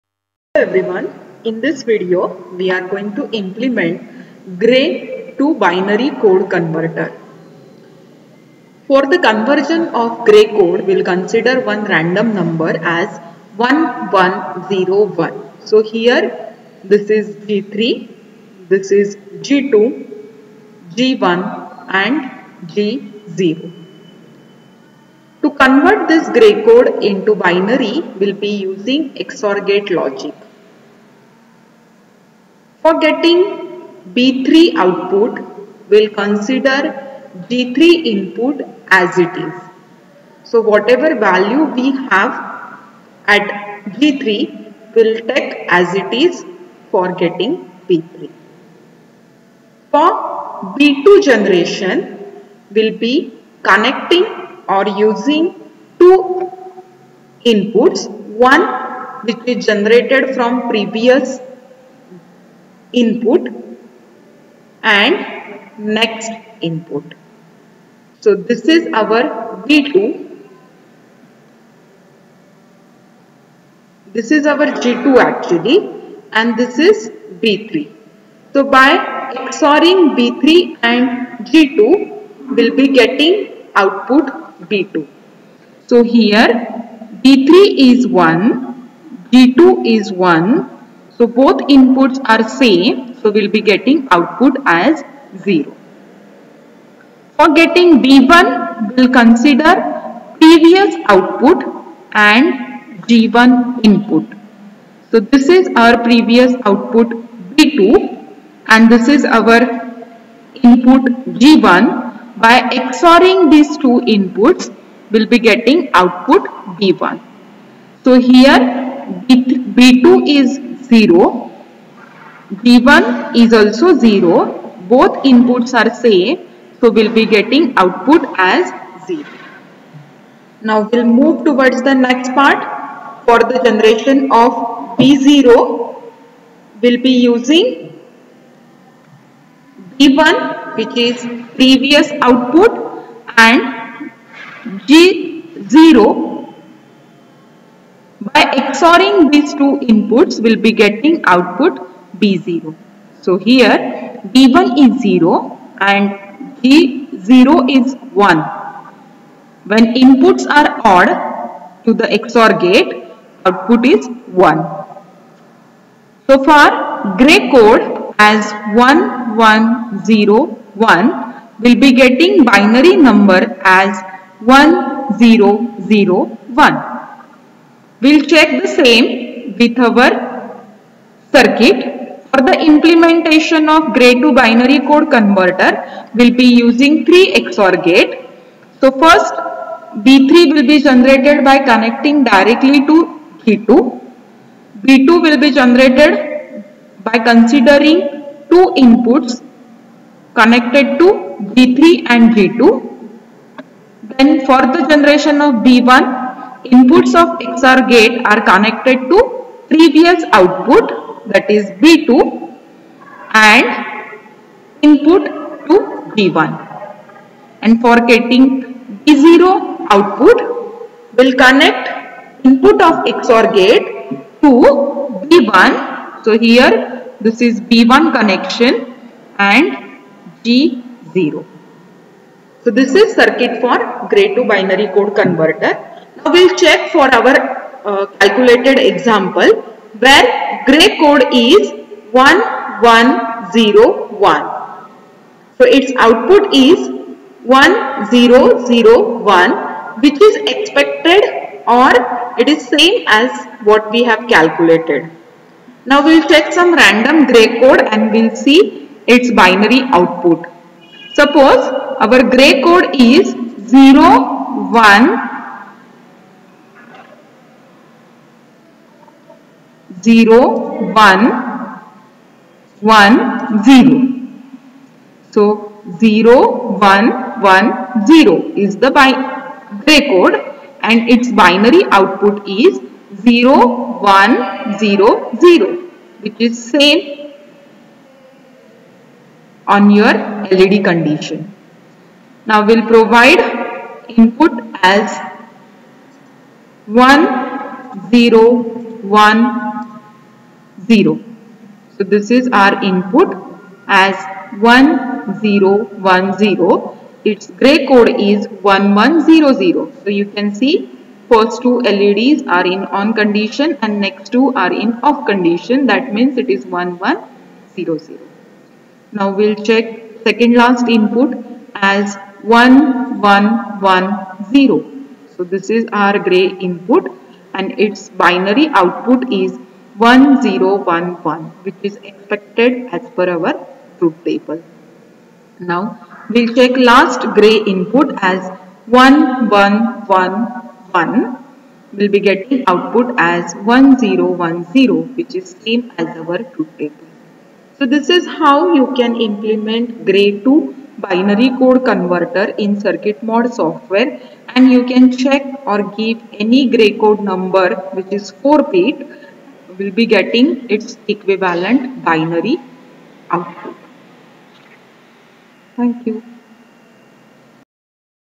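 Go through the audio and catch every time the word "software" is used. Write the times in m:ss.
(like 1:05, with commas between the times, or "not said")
5:53.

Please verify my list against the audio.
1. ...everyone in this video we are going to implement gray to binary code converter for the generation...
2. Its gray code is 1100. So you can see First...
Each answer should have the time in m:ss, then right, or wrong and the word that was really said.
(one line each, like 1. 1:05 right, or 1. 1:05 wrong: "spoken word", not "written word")
1. 0:00 wrong: "conversion", not "generation"
2. 5:07 right.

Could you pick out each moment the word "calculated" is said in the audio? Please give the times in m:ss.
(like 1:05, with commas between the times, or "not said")
3:58, 4:14.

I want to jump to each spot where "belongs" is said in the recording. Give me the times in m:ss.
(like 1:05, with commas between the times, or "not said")
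not said.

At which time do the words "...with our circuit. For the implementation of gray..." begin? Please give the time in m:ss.
2:59.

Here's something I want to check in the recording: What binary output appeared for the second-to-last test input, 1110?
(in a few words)
1011.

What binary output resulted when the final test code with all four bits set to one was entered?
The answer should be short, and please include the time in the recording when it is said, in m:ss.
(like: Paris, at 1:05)
1010, at 5:43.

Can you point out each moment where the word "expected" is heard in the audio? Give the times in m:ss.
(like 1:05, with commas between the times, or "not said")
4:10, 5:32.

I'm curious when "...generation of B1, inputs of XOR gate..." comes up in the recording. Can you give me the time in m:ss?
3:24.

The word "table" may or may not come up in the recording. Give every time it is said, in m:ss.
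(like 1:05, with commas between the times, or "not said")
5:34, 5:46.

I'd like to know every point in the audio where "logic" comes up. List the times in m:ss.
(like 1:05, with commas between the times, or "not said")
0:29.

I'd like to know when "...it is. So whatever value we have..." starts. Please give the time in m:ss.
0:39.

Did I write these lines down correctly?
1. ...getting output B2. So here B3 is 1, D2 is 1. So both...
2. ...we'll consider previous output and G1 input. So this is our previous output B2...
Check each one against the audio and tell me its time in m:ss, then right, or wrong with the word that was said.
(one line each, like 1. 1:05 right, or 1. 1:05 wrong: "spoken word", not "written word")
1. 1:22 right
2. 1:38 right.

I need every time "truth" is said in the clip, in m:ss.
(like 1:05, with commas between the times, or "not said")
5:33, 5:46.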